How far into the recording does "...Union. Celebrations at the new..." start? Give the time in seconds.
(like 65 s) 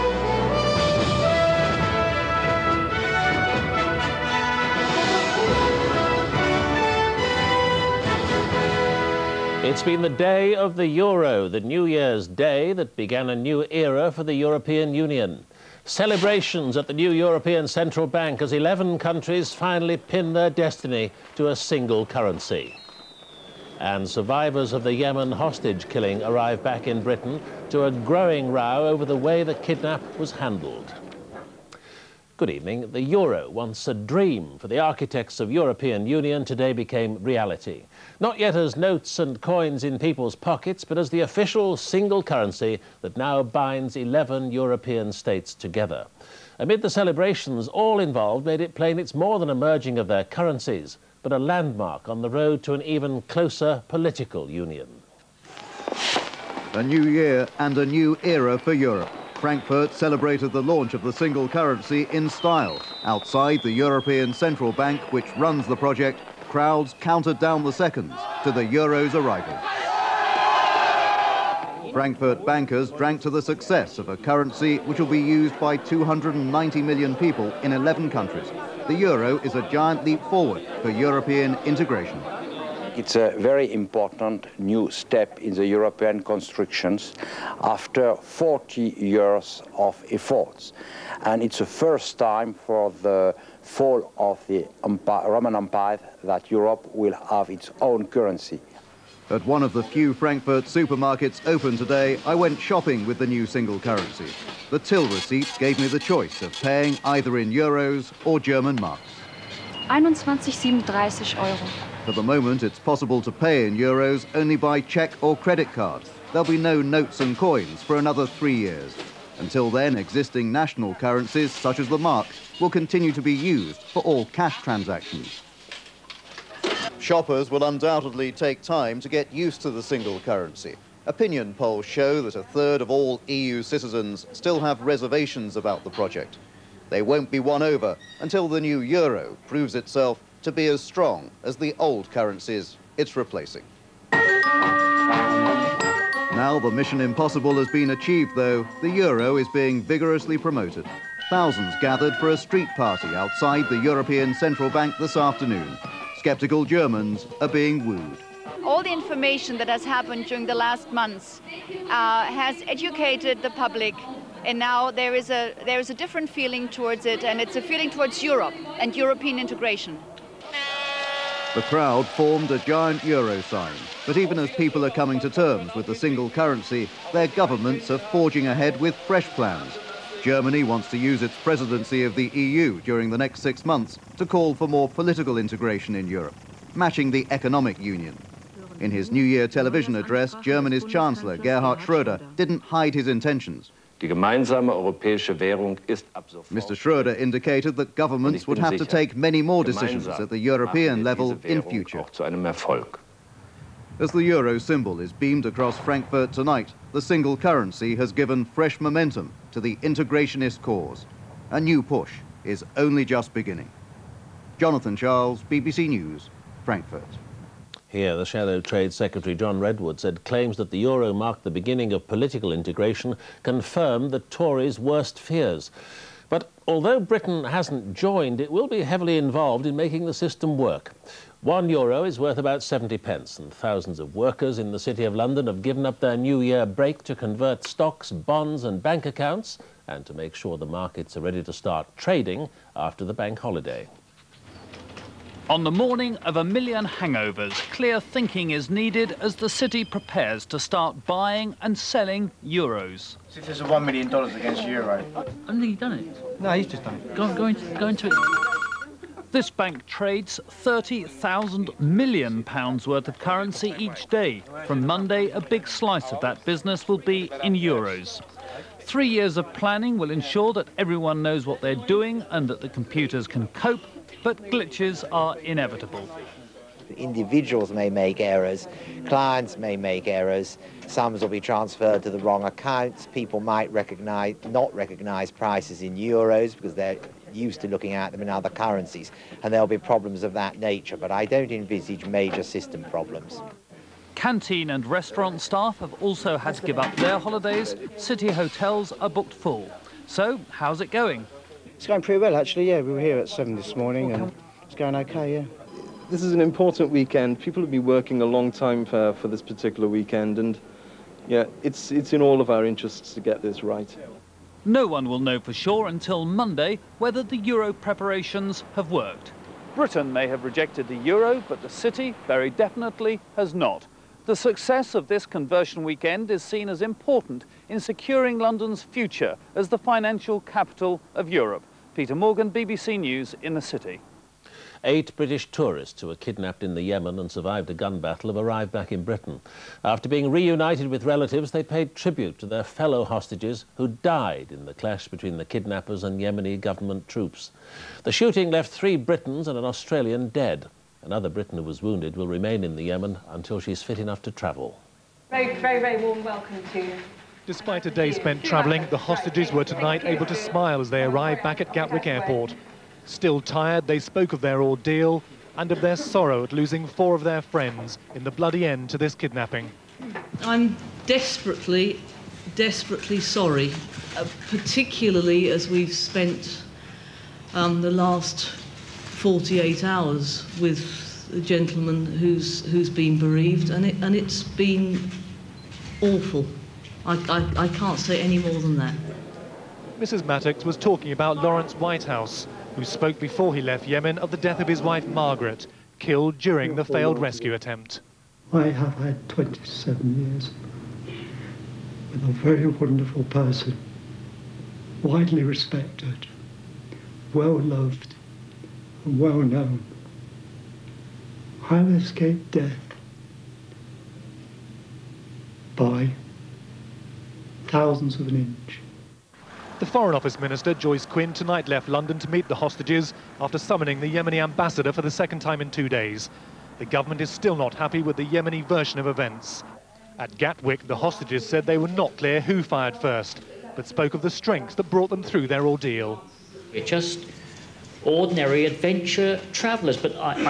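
14 s.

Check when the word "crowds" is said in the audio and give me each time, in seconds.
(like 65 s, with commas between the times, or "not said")
66 s, 171 s.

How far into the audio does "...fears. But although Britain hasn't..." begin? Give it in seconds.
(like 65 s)
225 s.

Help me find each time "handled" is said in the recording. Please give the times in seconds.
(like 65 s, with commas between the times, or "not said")
30 s.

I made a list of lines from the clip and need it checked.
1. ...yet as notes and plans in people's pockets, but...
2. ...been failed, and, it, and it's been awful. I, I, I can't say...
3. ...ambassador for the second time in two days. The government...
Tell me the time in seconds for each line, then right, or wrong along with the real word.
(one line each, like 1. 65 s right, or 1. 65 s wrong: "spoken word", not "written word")
1. 38 s wrong: "coins", not "plans"
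2. 382 s wrong: "bereaved", not "failed"
3. 424 s right.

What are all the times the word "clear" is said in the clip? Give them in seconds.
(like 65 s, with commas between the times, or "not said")
247 s, 432 s.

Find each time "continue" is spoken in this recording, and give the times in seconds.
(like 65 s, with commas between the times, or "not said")
122 s.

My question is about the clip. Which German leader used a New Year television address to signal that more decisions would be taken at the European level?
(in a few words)
Gerhard Schroeder.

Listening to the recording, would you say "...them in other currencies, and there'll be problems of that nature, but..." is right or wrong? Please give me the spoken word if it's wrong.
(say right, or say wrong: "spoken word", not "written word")
right.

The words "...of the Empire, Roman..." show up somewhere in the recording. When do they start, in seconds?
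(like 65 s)
94 s.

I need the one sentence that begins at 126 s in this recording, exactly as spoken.
Shoppers will undoubtedly take time to get used to the single currency.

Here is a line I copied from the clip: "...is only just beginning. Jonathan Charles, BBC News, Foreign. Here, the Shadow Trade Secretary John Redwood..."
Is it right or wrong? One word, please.
wrong.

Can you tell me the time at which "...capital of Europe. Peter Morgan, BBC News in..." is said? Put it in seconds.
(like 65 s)
330 s.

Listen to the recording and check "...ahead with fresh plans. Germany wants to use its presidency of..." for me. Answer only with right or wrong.
right.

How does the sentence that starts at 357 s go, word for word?
Despite a day spent travelling, the hostages were tonight able to smile as they arrived back at Gatwick Airport.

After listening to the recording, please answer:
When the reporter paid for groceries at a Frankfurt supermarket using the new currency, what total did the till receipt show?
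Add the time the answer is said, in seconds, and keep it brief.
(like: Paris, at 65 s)
21.37 euros, at 109 s.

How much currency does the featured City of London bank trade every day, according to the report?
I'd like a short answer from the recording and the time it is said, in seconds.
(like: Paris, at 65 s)
30,000 million pounds, at 260 s.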